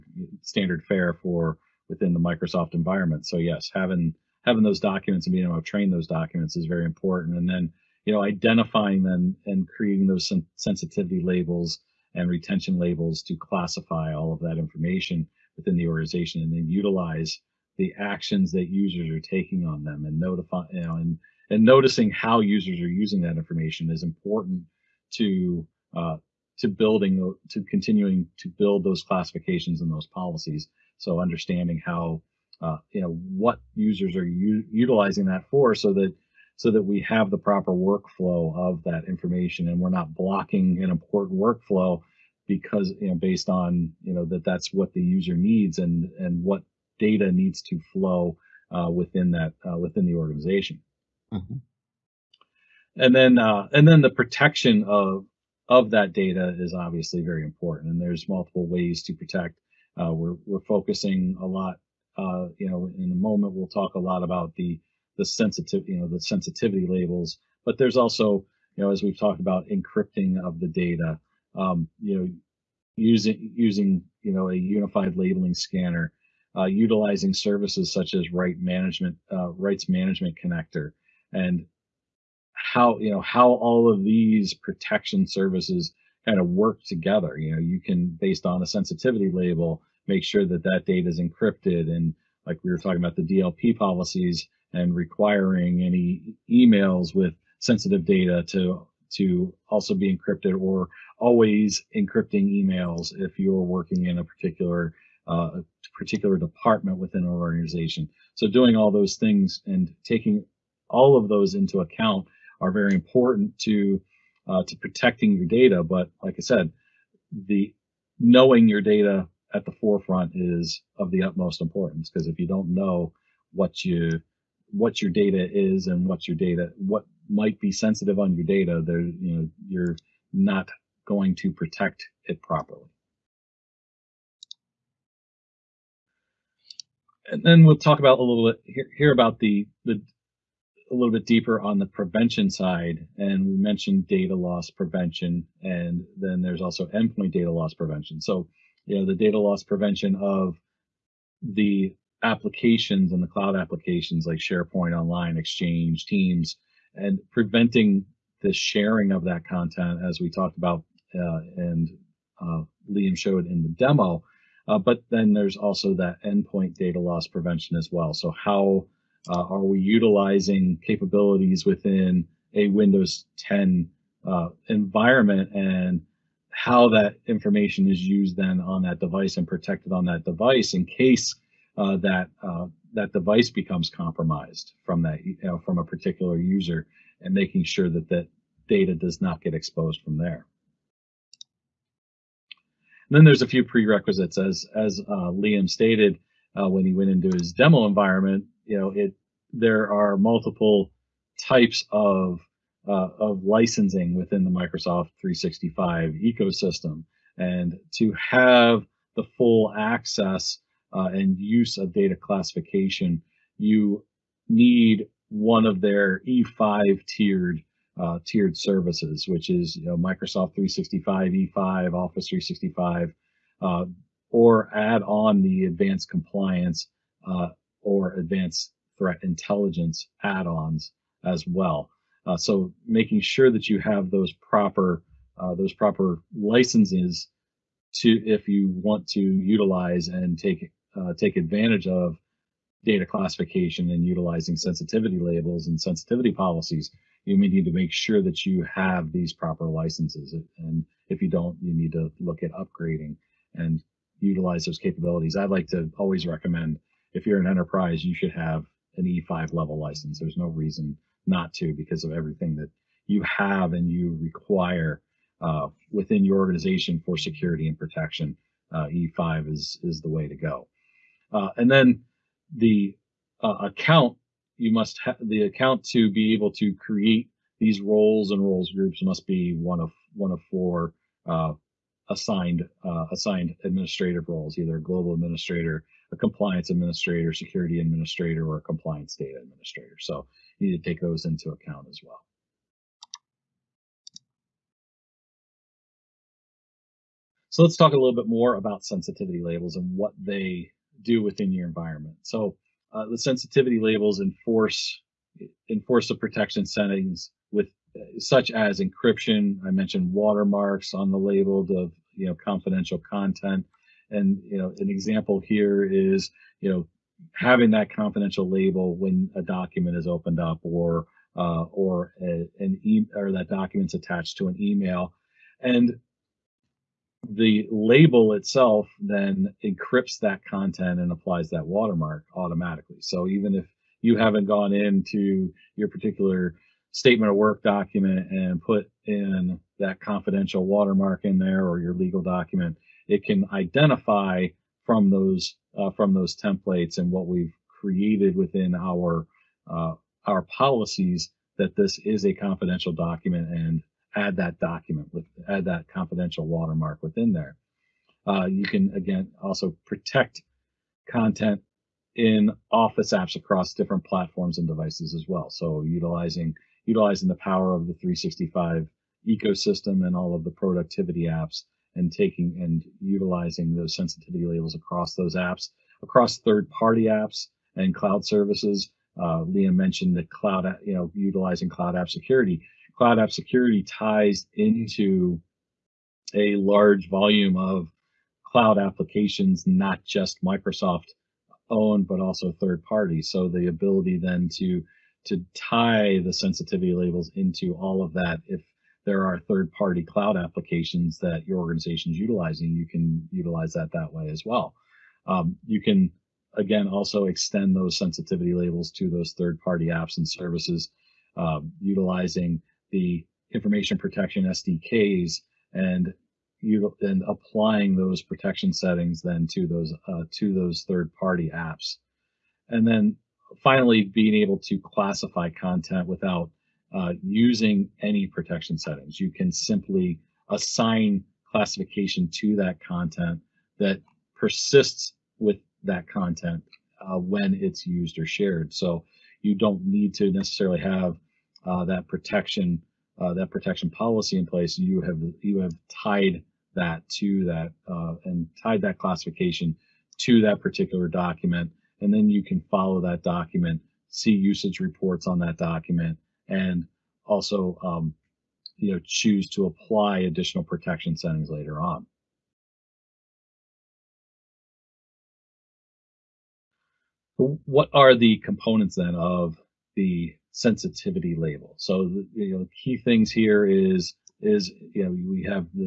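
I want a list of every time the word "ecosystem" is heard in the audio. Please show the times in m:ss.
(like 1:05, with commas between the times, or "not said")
3:26, 6:09.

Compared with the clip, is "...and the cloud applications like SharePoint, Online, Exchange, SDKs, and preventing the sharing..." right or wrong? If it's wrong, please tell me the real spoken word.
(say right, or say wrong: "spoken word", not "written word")
wrong: "Teams", not "SDKs".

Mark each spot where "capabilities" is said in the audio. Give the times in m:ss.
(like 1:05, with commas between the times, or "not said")
2:50, 4:14.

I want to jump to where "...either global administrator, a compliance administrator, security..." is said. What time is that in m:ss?
4:44.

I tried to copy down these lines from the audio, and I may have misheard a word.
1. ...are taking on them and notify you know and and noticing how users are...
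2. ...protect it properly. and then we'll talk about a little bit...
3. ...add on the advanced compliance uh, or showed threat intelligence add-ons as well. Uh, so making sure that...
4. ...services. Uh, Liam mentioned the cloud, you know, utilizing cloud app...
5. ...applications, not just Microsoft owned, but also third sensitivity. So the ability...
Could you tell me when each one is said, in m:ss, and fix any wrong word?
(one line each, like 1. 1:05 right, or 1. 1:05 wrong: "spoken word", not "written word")
1. 0:19 right
2. 2:11 right
3. 3:44 wrong: "advanced", not "showed"
4. 6:18 right
5. 6:28 wrong: "party", not "sensitivity".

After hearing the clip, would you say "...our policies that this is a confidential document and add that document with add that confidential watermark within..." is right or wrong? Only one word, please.
right.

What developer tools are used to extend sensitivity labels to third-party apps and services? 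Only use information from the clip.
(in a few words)
information protection SDKs.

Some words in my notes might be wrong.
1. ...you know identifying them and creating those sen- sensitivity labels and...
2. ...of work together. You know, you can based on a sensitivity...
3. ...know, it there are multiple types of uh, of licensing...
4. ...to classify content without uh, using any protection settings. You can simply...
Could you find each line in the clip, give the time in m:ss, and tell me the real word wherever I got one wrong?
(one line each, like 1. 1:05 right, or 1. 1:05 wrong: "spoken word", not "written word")
1. 0:08 right
2. 1:26 right
3. 3:18 right
4. 7:04 right.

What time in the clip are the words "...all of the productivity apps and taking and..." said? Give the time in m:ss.
6:10.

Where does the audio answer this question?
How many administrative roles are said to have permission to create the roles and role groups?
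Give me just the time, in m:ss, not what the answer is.
4:40.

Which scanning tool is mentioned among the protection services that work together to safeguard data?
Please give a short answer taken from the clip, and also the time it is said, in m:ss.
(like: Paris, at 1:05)
unified labeling scanner, at 1:14.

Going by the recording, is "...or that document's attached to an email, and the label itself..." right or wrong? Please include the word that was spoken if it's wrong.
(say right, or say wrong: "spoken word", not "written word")
right.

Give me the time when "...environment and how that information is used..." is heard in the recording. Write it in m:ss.
2:54.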